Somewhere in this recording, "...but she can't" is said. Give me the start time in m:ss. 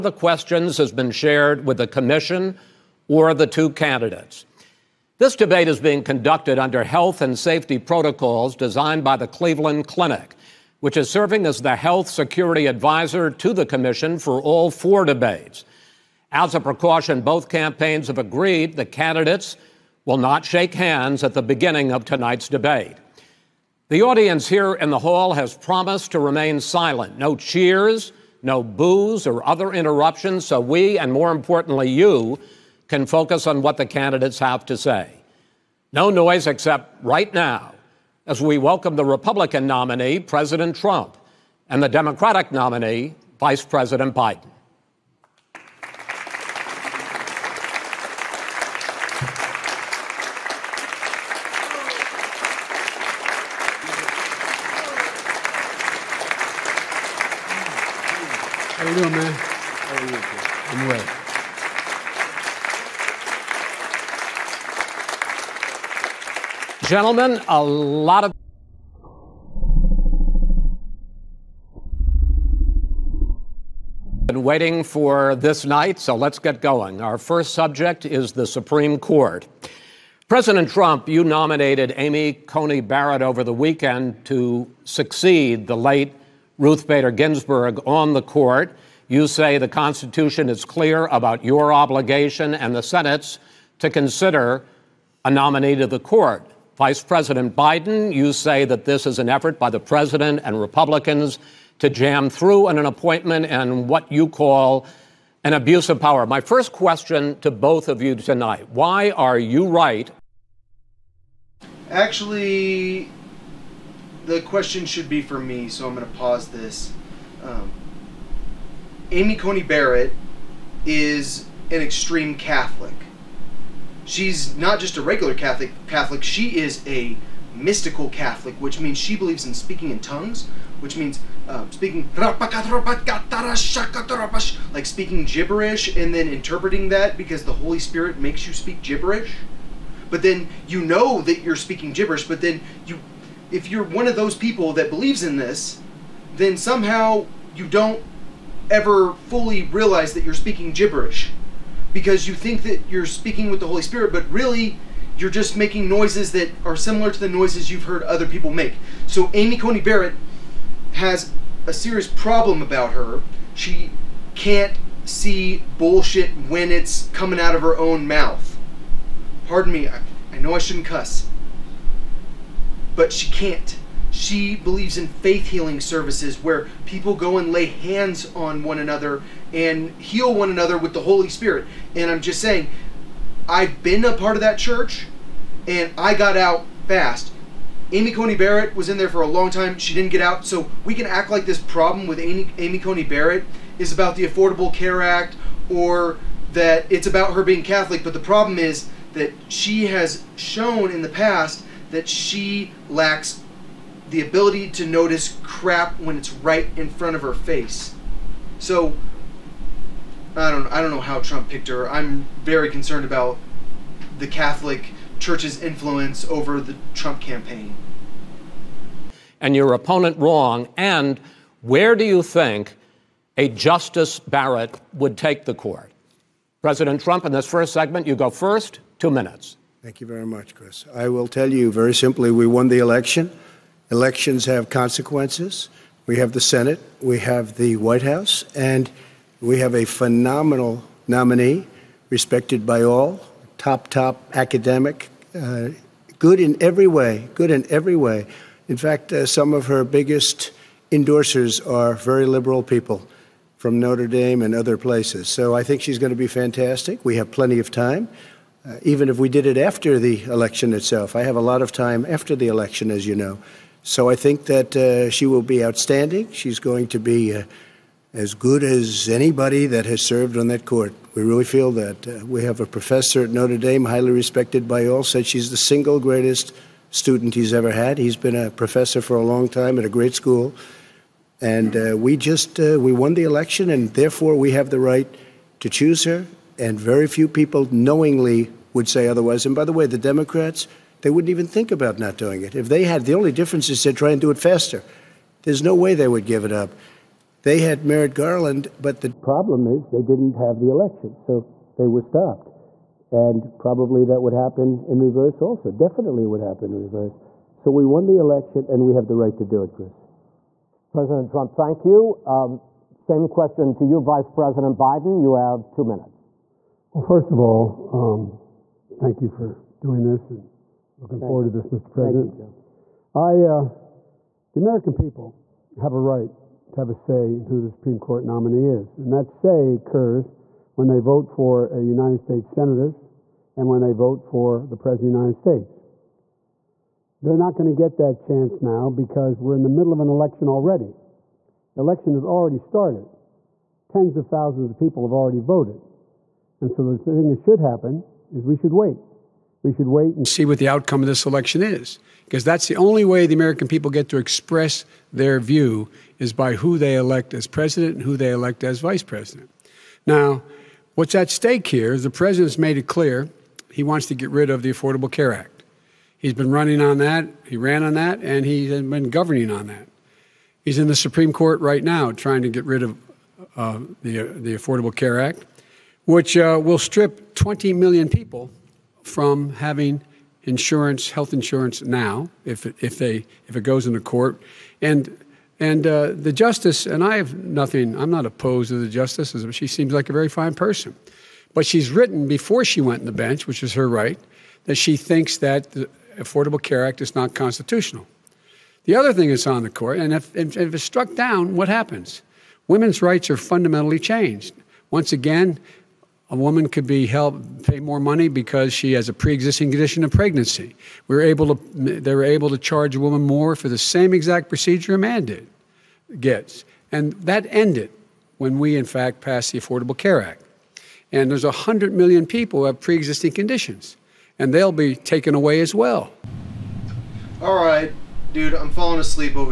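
2:52.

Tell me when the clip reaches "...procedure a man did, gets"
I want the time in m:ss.
6:54.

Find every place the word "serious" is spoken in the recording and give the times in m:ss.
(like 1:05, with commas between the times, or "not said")
2:41.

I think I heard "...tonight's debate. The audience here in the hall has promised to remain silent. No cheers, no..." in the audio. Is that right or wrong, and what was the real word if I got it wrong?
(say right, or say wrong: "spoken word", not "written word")
right.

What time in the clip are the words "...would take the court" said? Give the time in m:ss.
3:44.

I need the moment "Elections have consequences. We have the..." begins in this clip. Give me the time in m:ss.
3:53.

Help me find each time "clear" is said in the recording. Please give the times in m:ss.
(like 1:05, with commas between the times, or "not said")
1:30, 6:02.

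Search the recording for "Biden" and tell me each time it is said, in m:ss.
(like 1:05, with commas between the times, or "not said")
0:44, 1:37, 5:14.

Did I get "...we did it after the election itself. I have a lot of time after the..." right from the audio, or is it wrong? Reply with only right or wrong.
right.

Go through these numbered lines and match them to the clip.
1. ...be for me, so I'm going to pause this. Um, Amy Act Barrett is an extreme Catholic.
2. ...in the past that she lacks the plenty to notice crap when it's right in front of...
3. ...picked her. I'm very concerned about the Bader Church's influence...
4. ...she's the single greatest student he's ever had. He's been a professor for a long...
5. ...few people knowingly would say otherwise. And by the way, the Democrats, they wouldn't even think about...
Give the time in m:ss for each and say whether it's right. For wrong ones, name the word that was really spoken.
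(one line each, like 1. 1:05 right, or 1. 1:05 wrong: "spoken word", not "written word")
1. 1:55 wrong: "Coney", not "Act"
2. 3:20 wrong: "ability", not "plenty"
3. 3:31 wrong: "Catholic", not "Bader"
4. 4:35 right
5. 4:47 right.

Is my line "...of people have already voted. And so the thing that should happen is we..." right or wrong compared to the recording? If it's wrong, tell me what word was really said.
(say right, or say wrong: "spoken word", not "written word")
right.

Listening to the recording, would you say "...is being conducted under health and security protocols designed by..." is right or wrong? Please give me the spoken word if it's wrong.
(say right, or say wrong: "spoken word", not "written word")
wrong: "safety", not "security".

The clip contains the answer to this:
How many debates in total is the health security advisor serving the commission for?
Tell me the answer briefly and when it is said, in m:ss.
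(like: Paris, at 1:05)
4, at 0:14.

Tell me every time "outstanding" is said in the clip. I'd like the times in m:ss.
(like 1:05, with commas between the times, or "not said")
4:25.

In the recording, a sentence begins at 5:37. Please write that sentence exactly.
They're not going to get that chance now because we're in the middle of an election already.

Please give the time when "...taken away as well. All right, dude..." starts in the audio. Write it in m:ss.
7:04.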